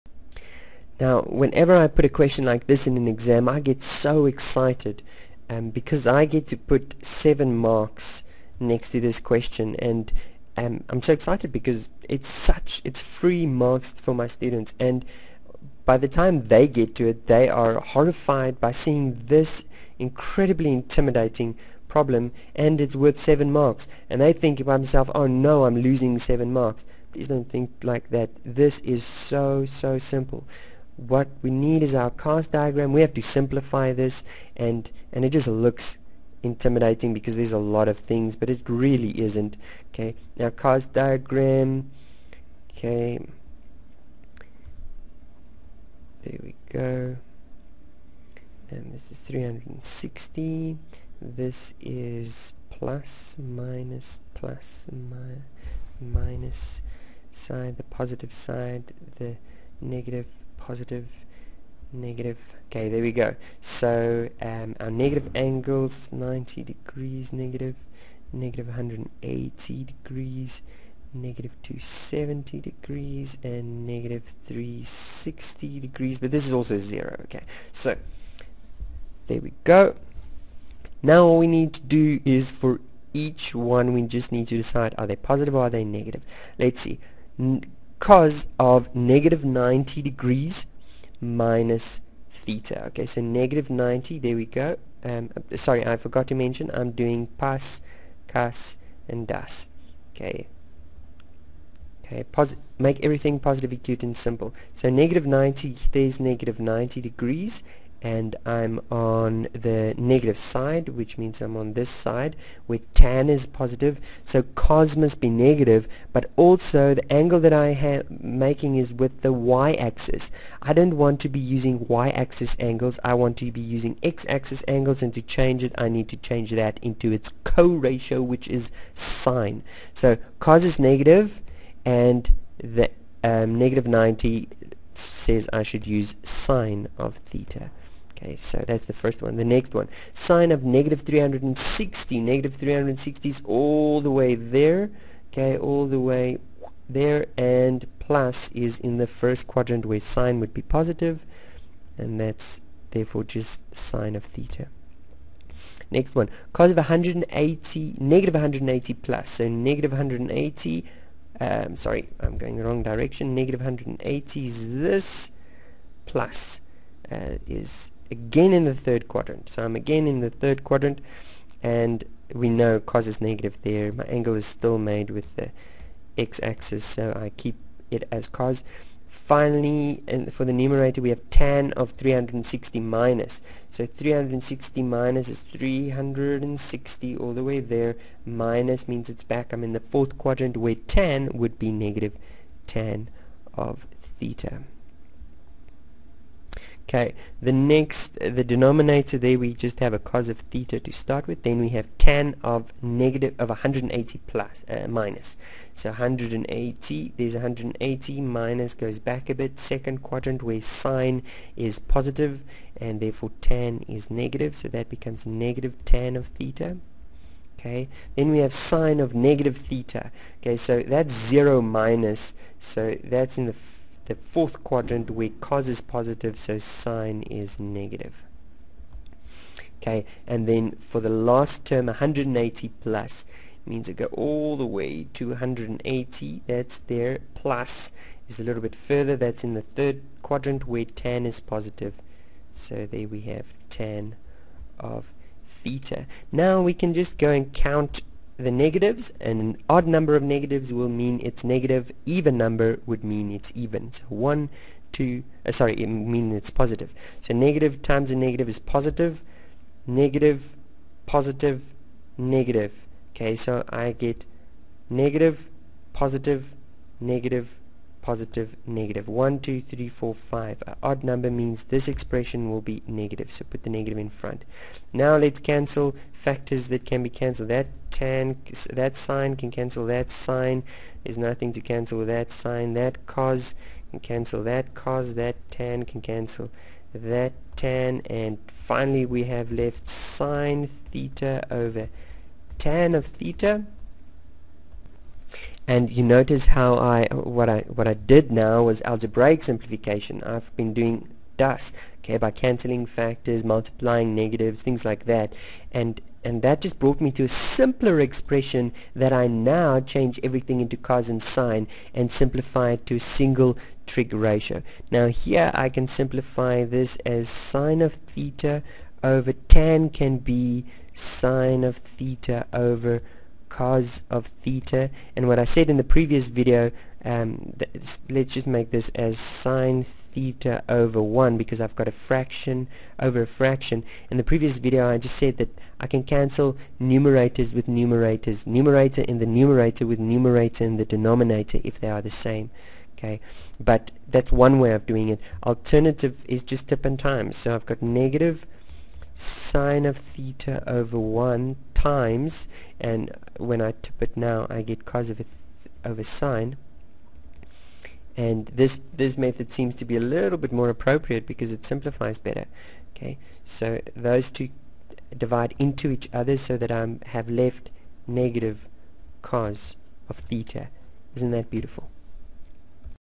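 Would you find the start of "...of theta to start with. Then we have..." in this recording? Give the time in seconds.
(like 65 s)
200 s.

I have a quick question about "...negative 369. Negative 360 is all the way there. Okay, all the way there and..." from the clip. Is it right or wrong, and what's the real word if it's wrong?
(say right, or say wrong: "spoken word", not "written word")
wrong: "360", not "369".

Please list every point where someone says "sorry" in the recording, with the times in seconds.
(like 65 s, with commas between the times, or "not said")
95 s, 161 s, 255 s.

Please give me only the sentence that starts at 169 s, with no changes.
So I'm again in the third quadrant and we know cos is negative there.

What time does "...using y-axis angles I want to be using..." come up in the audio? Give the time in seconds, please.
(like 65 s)
121 s.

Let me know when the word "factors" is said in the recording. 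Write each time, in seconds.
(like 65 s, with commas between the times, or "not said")
276 s, 302 s.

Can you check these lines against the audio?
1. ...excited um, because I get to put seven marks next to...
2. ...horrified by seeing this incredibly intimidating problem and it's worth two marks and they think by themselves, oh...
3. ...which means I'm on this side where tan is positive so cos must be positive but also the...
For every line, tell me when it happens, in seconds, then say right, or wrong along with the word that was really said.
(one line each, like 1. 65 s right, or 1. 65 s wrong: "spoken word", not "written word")
1. 4 s right
2. 17 s wrong: "seven", not "two"
3. 110 s wrong: "negative", not "positive".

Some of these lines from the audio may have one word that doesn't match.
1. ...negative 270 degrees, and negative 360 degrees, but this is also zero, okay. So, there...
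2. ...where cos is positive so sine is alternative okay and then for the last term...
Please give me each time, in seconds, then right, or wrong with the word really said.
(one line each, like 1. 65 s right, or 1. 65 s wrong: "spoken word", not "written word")
1. 71 s right
2. 225 s wrong: "negative", not "alternative".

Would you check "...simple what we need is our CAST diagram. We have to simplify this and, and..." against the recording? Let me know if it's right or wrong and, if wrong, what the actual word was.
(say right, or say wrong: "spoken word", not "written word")
right.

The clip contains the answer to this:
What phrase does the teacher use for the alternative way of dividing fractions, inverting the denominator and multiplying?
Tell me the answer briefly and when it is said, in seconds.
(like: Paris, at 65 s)
tip and time, at 346 s.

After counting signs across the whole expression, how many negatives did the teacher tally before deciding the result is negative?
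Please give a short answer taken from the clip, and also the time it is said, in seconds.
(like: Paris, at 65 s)
5, at 270 s.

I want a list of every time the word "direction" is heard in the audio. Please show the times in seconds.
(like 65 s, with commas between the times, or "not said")
162 s.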